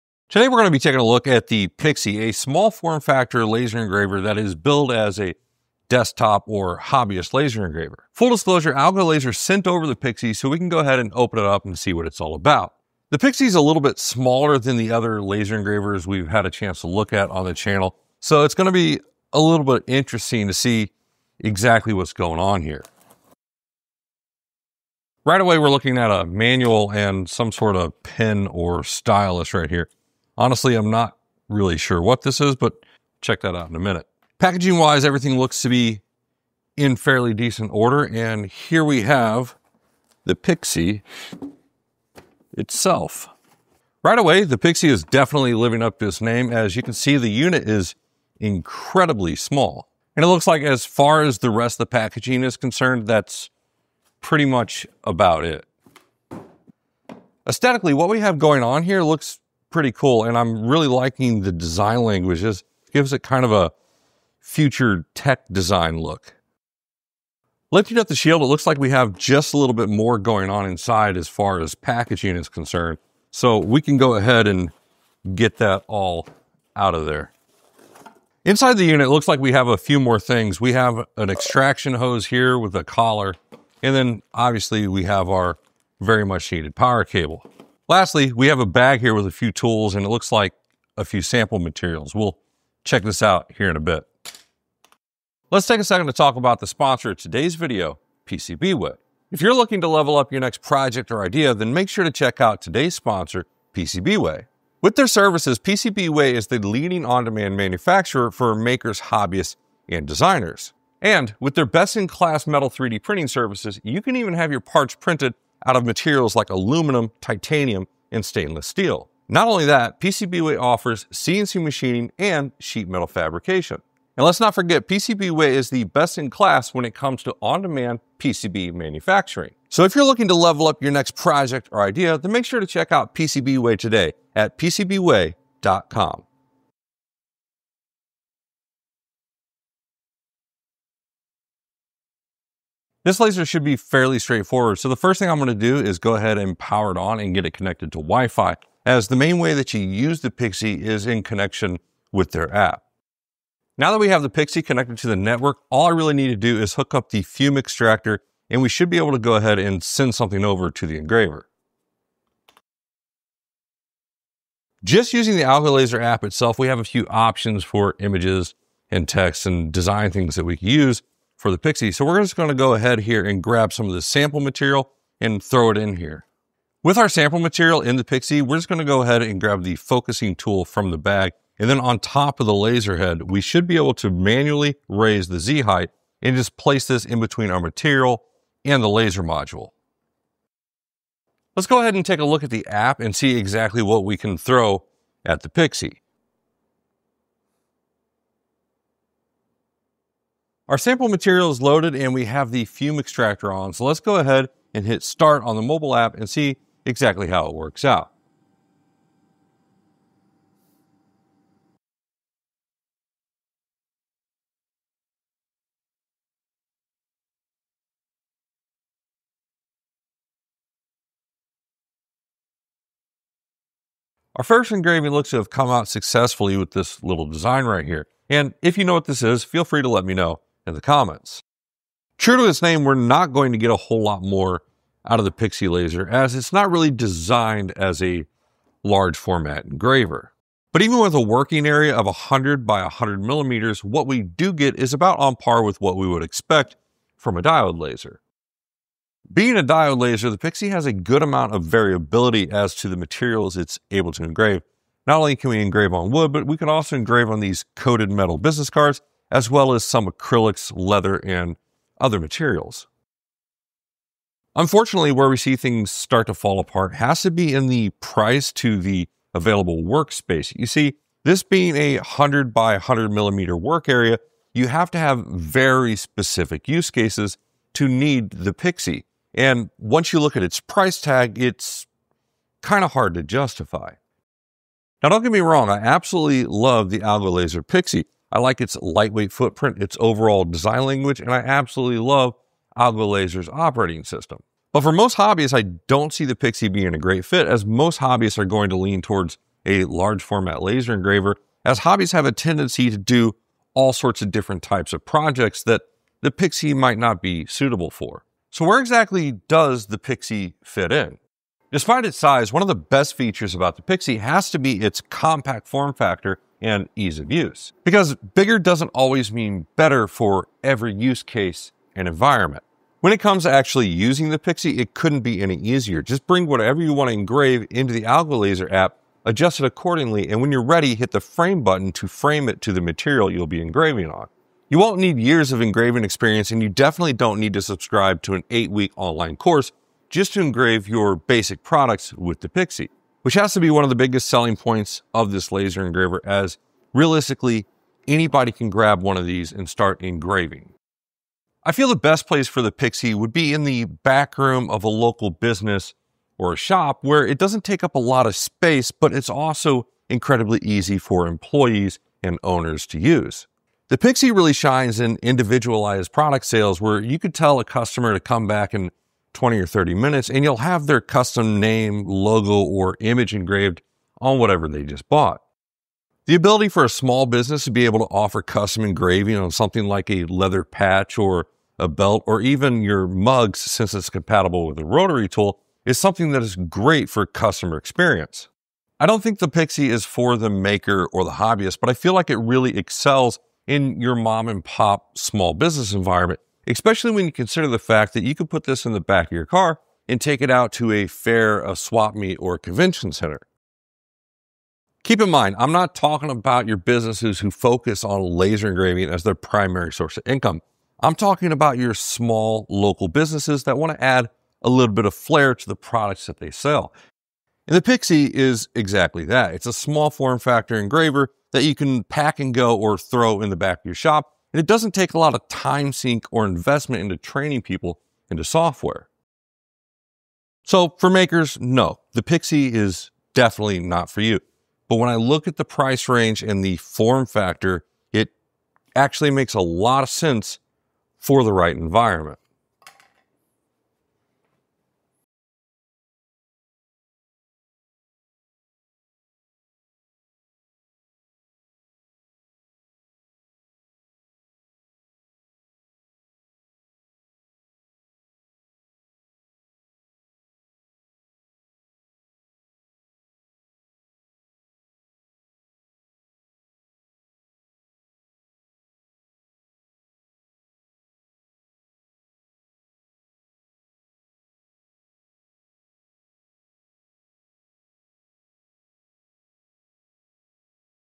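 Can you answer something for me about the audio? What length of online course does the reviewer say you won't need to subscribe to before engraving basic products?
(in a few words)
Eight week.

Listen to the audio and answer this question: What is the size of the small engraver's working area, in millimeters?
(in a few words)
100 by 100 millimeters.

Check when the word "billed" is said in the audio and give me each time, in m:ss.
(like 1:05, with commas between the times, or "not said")
0:04.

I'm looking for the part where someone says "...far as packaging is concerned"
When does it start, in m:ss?
1:11.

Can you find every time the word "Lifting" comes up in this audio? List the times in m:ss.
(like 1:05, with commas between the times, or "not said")
1:07.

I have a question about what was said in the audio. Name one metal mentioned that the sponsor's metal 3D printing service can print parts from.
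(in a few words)
Titanium.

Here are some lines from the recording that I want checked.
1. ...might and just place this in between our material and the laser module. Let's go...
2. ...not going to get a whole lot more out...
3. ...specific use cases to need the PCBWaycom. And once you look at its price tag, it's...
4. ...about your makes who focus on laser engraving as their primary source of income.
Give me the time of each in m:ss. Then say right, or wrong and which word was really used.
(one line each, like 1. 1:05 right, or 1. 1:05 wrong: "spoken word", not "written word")
1. 3:05 wrong: "height", not "might"
2. 3:52 right
3. 4:35 wrong: "Pixi", not "PCBWaycom"
4. 6:46 wrong: "businesses", not "makes".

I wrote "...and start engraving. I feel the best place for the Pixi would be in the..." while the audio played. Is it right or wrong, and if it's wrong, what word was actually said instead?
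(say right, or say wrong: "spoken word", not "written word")
right.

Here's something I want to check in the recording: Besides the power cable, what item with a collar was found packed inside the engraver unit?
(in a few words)
Extraction hose.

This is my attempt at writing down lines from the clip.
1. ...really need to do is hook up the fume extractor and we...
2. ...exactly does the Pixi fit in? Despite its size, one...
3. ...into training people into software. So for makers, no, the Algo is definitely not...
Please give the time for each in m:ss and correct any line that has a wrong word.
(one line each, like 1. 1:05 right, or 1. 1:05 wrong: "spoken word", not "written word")
1. 2:35 right
2. 5:08 right
3. 7:07 wrong: "Pixi", not "Algo".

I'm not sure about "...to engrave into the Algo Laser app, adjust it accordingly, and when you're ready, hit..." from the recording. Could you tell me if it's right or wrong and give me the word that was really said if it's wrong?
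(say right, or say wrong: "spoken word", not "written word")
right.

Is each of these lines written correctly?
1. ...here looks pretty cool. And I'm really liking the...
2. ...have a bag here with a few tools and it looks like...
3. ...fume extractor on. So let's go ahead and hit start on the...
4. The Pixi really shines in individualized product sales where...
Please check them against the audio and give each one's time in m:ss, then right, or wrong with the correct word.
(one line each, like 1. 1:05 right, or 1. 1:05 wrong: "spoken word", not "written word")
1. 0:58 right
2. 1:28 right
3. 3:22 right
4. 6:03 right.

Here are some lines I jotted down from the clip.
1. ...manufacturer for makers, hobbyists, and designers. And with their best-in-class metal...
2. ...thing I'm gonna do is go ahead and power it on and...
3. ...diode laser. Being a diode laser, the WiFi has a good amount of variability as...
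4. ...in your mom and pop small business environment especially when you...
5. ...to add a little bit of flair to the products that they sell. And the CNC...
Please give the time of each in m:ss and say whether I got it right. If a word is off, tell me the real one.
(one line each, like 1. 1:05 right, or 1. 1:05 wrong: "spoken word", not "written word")
1. 1:47 right
2. 2:25 right
3. 4:07 wrong: "Pixi", not "WiFi"
4. 6:33 right
5. 6:53 wrong: "Pixi", not "CNC".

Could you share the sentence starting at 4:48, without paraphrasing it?
I like its lightweight footprint, its overall design language, and I absolutely love Algo Laser's operating system.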